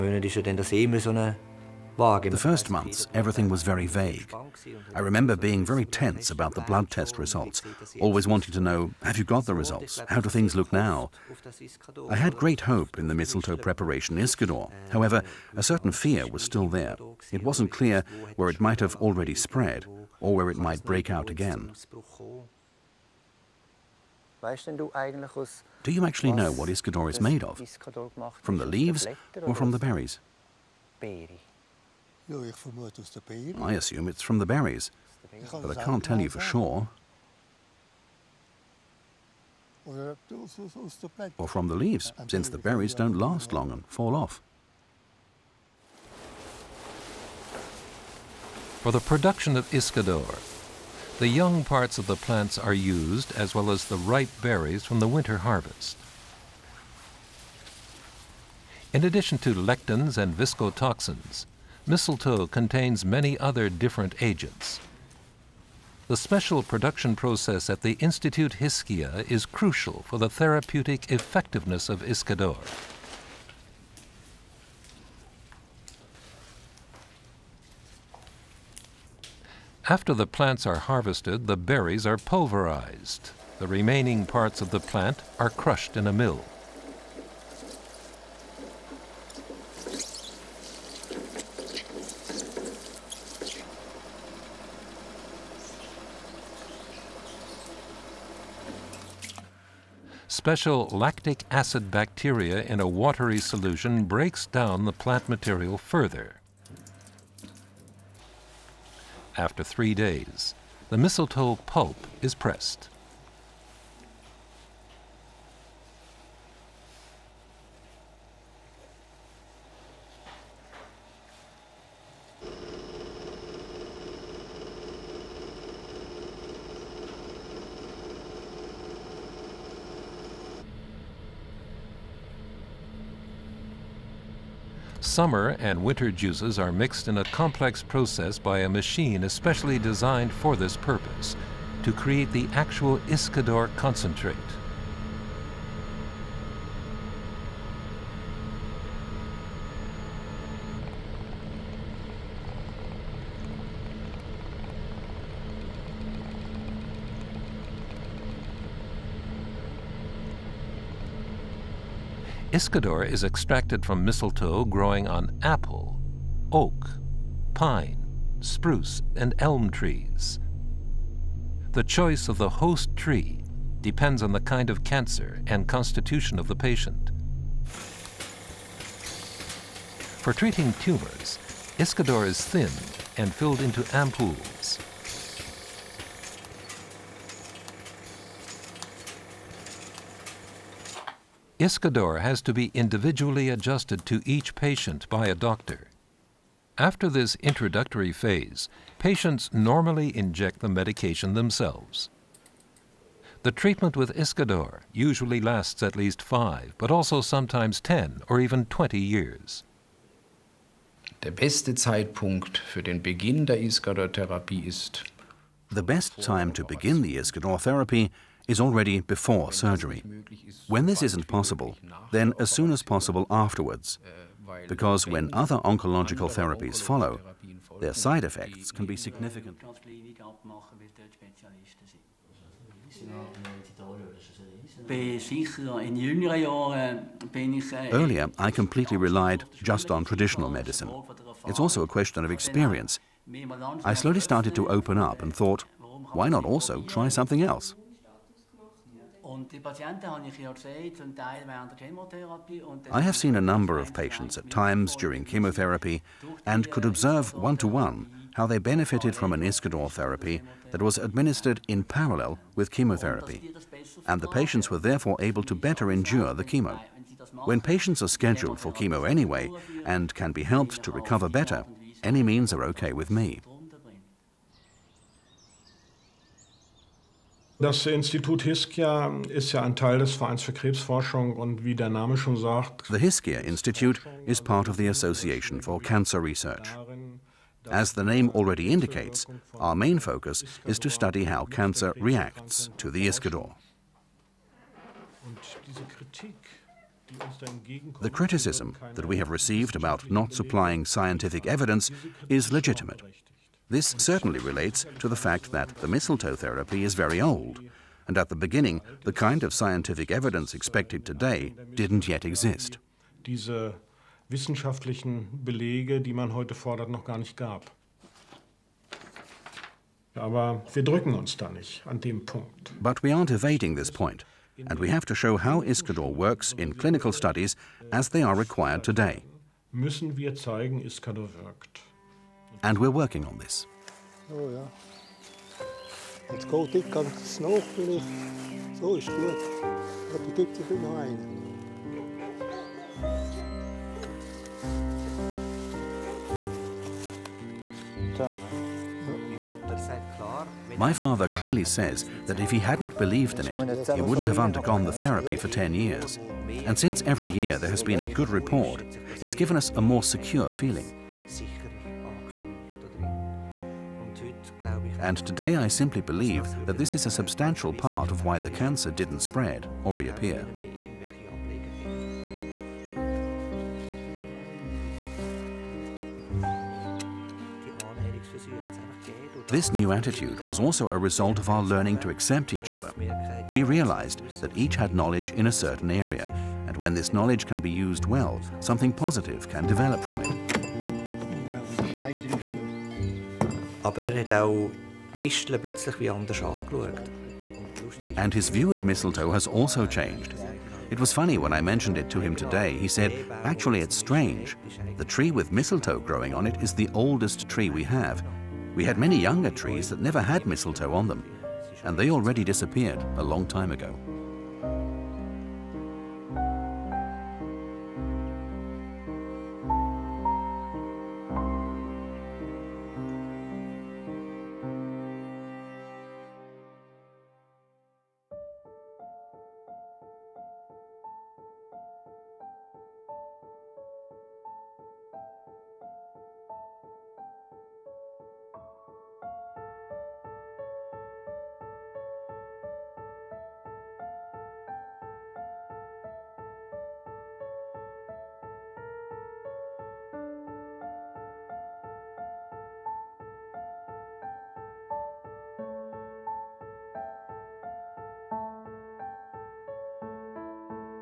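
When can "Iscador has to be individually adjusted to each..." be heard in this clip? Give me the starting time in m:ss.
3:11.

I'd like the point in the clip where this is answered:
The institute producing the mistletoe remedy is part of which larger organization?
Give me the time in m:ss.
4:44.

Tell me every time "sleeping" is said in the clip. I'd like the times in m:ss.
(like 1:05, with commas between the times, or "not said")
not said.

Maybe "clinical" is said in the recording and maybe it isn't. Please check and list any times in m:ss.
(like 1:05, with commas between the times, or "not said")
5:26.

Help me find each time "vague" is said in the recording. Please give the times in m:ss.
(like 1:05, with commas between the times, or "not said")
0:03.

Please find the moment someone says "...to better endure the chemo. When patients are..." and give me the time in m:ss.
4:25.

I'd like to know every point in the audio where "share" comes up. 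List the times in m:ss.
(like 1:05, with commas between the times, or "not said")
not said.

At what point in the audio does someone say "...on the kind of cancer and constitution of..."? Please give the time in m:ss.
2:54.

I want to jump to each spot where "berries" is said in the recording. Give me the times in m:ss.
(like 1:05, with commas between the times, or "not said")
0:29, 0:34, 0:42, 0:54, 1:21.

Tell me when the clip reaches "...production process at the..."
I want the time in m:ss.
1:06.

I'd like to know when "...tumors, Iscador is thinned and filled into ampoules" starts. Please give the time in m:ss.
3:00.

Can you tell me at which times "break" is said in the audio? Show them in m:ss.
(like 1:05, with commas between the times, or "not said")
0:20, 1:44.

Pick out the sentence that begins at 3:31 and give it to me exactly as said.
The best time to begin the Iscador therapy is already before surgery.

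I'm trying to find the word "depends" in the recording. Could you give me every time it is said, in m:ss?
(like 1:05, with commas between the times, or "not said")
2:53.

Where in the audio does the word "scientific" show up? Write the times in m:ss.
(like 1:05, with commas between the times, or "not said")
5:00, 5:09.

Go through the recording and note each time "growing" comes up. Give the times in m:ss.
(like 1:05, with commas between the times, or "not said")
2:44, 6:45.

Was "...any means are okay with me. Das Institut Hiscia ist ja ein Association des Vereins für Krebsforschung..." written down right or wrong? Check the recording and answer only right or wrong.
wrong.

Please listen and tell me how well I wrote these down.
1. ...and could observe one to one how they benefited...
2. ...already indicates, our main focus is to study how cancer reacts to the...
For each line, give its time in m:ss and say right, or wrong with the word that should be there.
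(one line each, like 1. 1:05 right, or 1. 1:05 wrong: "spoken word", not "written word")
1. 4:16 right
2. 4:48 right.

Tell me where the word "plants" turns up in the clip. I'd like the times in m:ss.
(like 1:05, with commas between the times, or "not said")
0:52, 1:20, 1:24, 1:44.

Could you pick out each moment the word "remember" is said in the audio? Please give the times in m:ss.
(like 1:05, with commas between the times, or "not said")
0:04.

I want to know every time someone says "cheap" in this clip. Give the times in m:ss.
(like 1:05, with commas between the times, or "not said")
not said.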